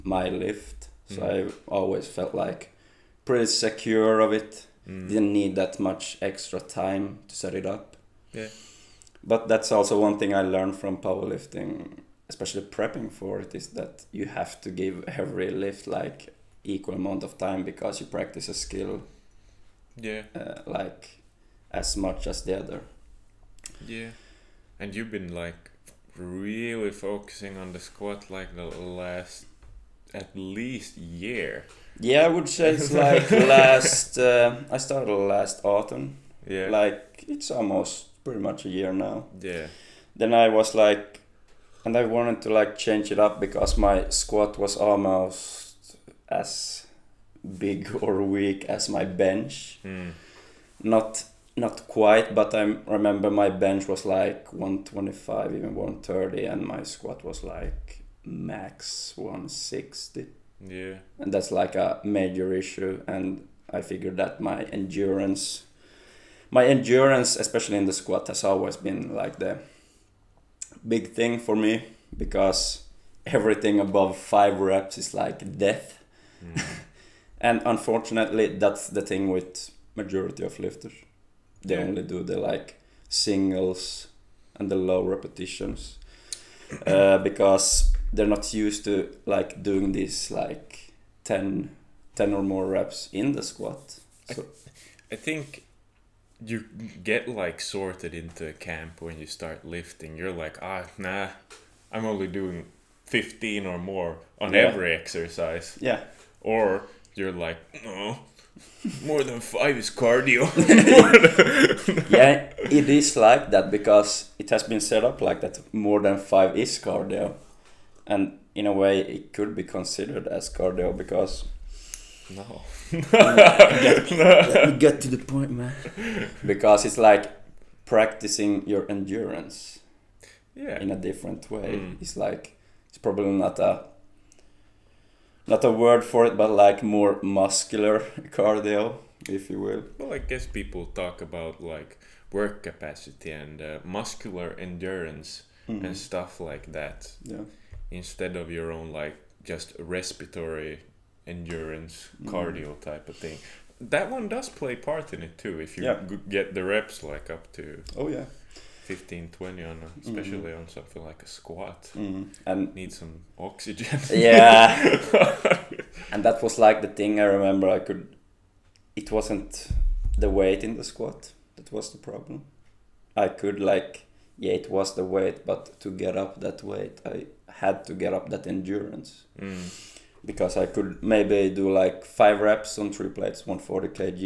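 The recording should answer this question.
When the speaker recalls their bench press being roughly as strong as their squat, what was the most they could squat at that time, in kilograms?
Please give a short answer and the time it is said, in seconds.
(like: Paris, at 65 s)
160, at 59 s.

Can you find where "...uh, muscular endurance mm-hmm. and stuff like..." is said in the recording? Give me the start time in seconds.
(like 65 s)
143 s.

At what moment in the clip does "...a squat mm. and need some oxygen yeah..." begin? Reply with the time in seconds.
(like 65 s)
161 s.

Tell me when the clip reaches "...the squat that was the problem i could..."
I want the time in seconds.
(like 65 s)
170 s.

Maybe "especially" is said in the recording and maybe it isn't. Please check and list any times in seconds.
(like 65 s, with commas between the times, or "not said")
12 s, 67 s, 160 s.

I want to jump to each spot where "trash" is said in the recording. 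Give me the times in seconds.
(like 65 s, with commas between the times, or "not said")
not said.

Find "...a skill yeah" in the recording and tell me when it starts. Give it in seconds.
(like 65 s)
18 s.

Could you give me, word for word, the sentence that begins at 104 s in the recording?
every exercise yeah or you're like, no, more than five is cardio.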